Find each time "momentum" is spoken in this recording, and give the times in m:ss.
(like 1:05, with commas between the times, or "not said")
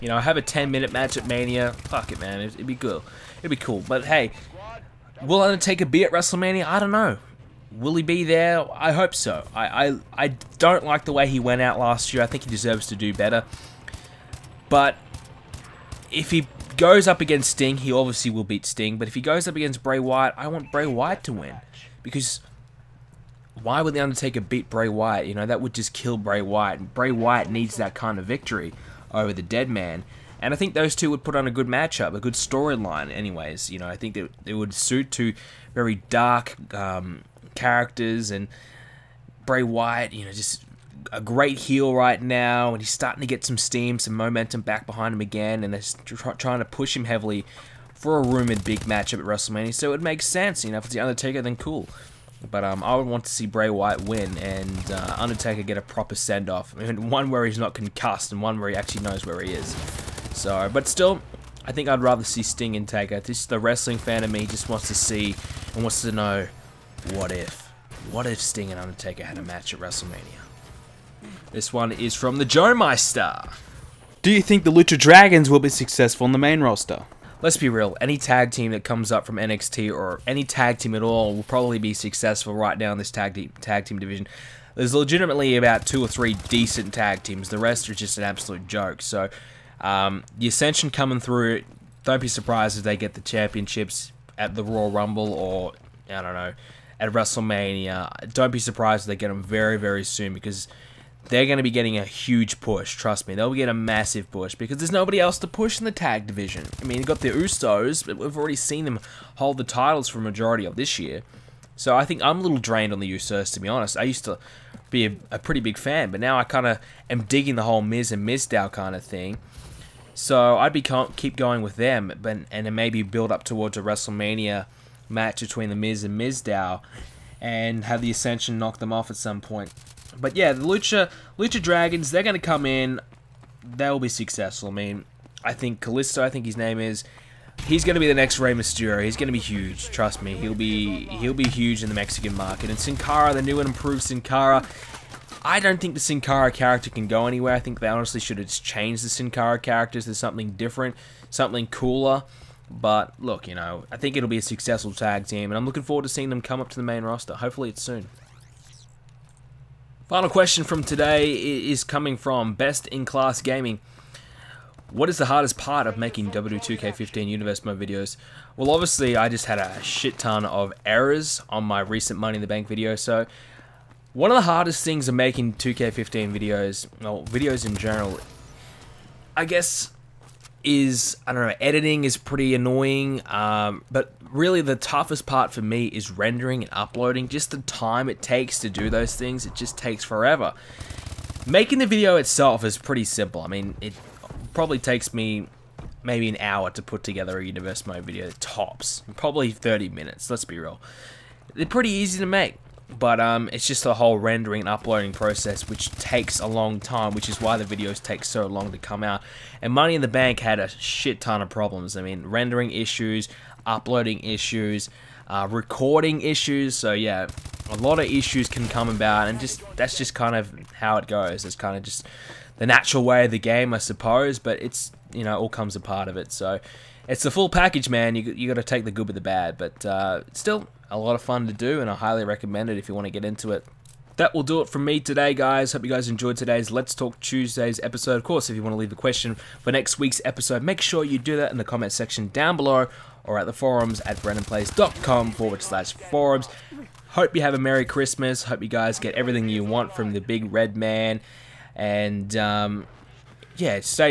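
0:44.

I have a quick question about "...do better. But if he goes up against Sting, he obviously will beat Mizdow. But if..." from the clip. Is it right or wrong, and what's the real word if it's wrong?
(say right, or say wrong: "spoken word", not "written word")
wrong: "Sting", not "Mizdow".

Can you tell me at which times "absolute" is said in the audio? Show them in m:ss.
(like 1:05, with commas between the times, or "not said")
1:28.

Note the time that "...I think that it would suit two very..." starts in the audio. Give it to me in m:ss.
0:33.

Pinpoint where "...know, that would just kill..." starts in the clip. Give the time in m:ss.
0:25.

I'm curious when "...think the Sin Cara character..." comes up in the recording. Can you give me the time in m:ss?
2:25.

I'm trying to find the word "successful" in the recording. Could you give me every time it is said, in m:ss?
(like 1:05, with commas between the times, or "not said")
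1:15, 1:21, 2:14, 2:34.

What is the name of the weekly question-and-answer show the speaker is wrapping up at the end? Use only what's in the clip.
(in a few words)
Let's Talk Tuesdays.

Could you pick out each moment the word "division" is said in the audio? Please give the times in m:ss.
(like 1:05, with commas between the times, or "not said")
1:23, 1:46.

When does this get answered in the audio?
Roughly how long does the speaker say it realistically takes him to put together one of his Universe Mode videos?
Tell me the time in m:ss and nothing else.
3:19.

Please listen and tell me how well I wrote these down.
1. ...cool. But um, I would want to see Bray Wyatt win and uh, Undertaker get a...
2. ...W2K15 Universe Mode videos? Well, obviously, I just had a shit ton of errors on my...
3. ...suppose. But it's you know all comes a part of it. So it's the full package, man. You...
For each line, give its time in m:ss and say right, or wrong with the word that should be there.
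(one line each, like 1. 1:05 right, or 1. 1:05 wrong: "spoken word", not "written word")
1. 0:51 right
2. 2:46 right
3. 3:43 right.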